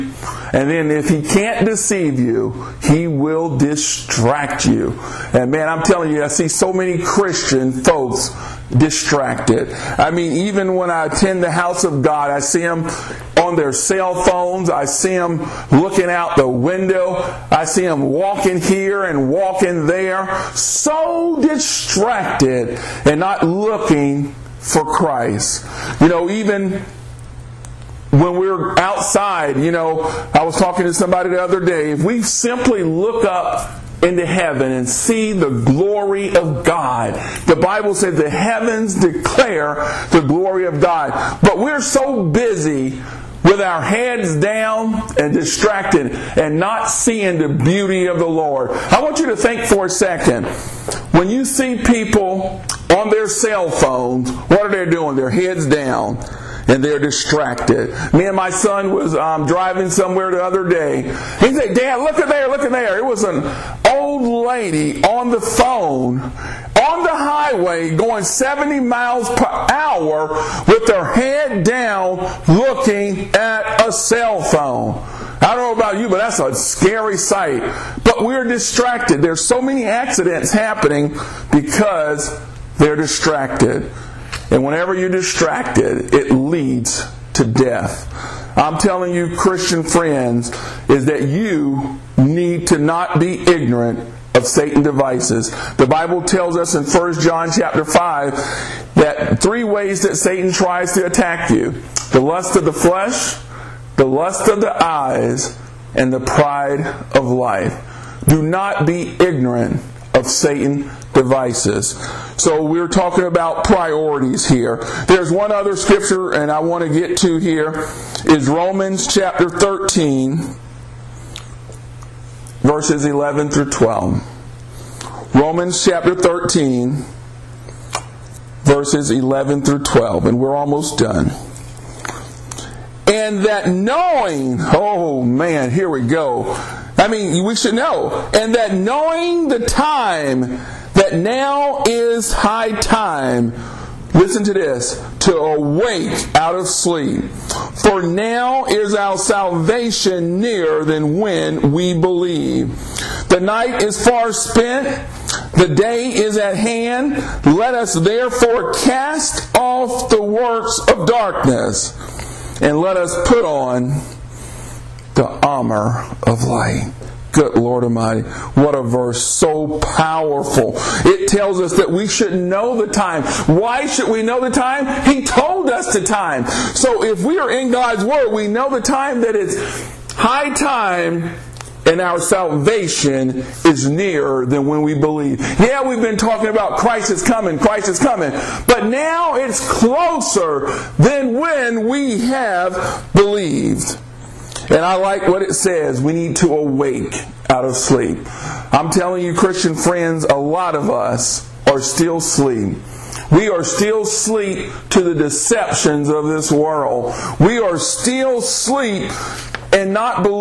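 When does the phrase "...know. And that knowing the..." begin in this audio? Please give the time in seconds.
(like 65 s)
137 s.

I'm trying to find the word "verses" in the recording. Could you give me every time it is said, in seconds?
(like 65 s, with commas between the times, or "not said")
122 s, 128 s, 168 s.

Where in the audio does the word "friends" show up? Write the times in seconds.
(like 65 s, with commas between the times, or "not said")
89 s, 199 s.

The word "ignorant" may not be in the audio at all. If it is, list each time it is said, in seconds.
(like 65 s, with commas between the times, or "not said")
93 s, 109 s.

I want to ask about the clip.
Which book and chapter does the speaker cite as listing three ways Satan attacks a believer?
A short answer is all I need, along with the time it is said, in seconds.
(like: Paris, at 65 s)
1 John chapter 5, at 96 s.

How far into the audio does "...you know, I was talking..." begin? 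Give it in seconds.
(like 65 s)
29 s.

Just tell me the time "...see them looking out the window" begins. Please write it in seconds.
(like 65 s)
14 s.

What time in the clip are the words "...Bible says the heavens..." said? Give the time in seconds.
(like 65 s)
37 s.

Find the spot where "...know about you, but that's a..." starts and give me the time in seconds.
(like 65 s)
75 s.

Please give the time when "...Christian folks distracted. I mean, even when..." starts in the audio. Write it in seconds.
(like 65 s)
7 s.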